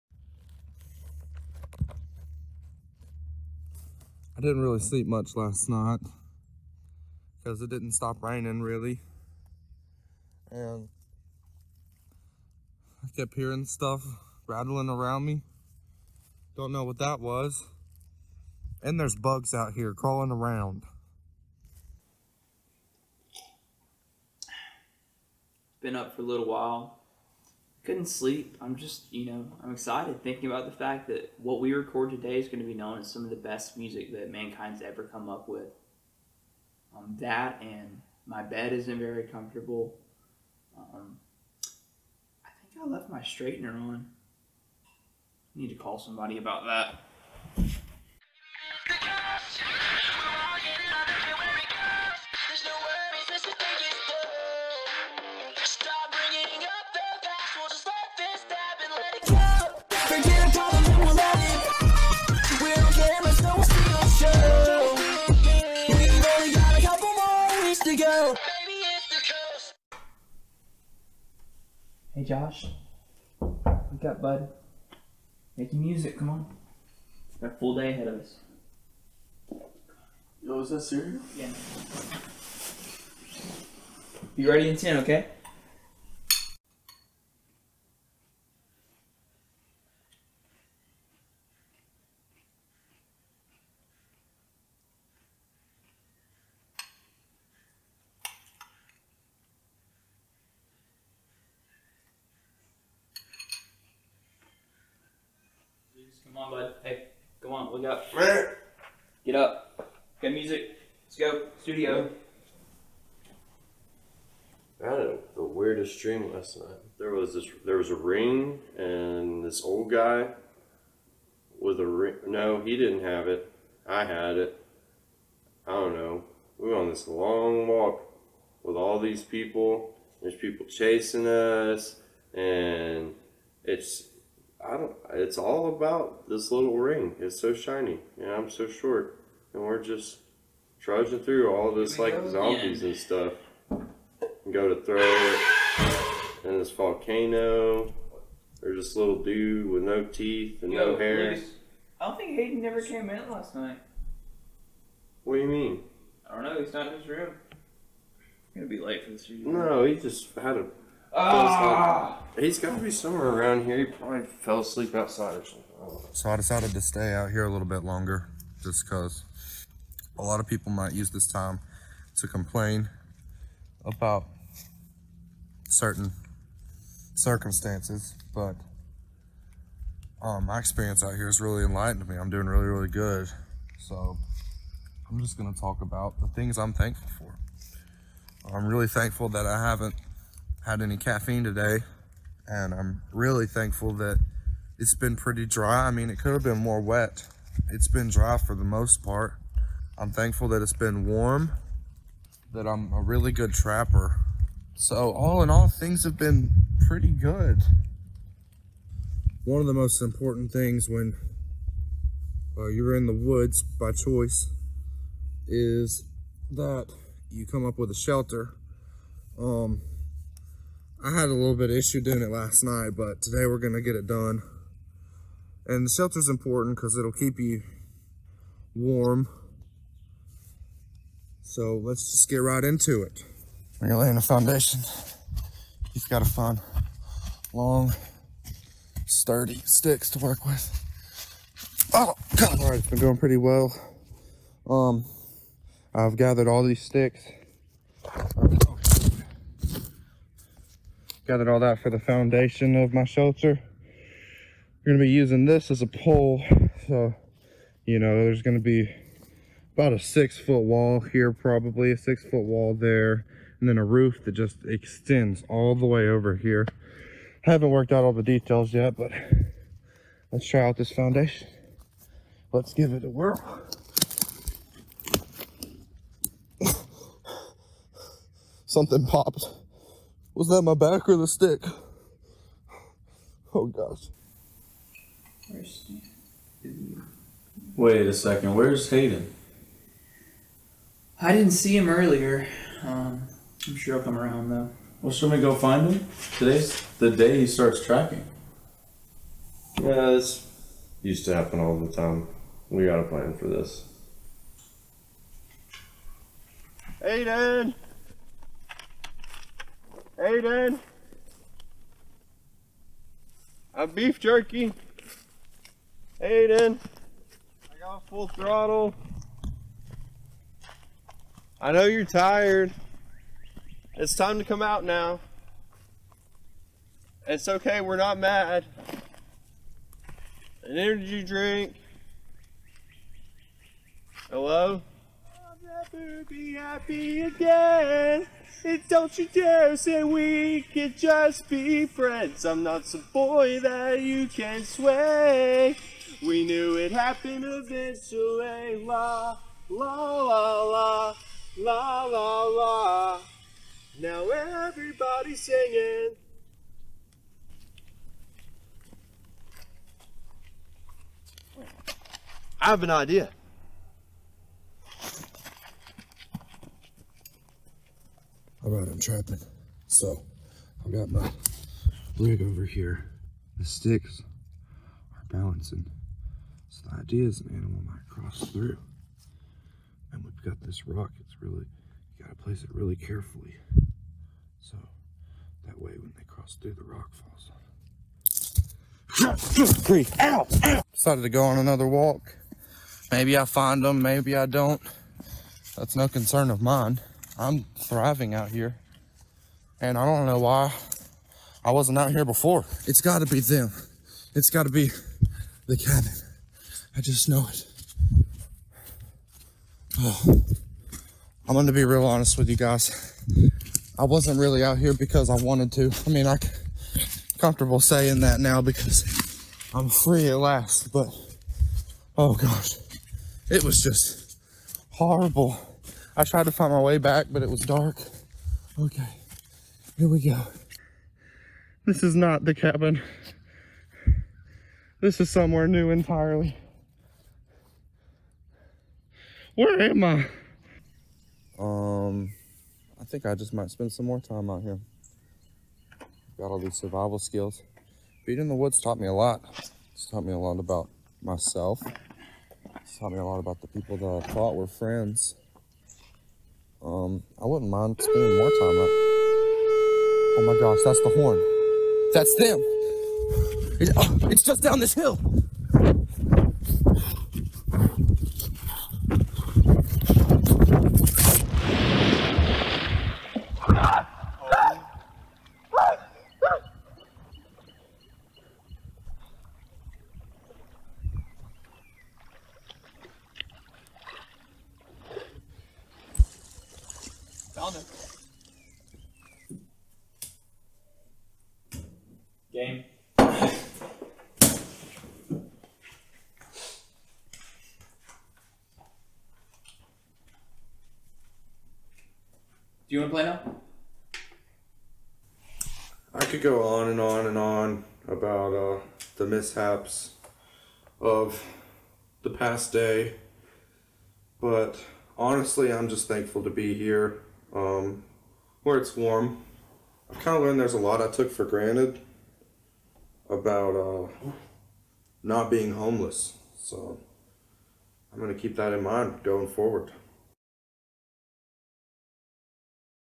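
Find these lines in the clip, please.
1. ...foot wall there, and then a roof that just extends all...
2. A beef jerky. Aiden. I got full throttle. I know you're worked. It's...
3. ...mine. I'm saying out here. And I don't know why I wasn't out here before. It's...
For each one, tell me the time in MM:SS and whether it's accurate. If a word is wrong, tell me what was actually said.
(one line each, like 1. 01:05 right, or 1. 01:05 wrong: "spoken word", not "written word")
1. 04:22 right
2. 05:13 wrong: "tired", not "worked"
3. 06:36 wrong: "thriving", not "saying".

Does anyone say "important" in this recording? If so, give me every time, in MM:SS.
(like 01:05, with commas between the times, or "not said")
03:30, 03:46.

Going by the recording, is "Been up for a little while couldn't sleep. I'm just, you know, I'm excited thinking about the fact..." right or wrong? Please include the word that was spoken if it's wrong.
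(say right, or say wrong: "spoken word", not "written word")
right.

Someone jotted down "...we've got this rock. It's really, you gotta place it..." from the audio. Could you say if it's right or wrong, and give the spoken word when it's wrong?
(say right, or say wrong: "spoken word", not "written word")
right.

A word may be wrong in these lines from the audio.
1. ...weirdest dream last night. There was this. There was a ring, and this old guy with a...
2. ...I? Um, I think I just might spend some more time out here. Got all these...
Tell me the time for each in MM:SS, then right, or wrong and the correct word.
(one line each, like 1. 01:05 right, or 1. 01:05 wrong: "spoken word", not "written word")
1. 01:55 right
2. 07:20 right.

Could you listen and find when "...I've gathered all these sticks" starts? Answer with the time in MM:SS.
04:05.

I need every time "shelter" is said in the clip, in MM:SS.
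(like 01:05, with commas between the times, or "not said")
03:37, 03:45, 04:13.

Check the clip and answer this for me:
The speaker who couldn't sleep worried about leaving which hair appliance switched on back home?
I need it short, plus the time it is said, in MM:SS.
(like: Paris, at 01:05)
straightener, at 00:43.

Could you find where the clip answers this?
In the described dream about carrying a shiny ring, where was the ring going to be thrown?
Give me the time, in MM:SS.
02:26.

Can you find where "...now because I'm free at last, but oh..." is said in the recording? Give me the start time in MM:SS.
06:58.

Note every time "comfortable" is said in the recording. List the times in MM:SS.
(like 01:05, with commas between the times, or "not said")
00:39, 06:57.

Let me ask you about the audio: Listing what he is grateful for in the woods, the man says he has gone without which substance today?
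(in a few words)
caffeine.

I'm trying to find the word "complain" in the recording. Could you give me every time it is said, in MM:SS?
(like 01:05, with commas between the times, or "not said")
02:52.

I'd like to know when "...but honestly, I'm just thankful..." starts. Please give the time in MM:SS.
08:34.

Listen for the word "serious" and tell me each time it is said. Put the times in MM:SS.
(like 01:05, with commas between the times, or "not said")
01:20.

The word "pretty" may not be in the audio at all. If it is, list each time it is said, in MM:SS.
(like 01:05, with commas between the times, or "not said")
03:15, 03:26, 04:03.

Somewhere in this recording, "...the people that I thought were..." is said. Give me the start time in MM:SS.
07:33.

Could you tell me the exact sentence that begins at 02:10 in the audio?
There's people chasing us, and it's it's all about this little ring.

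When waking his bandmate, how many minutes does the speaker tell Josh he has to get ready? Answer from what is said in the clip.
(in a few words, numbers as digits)
10.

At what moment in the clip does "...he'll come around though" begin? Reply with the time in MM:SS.
04:53.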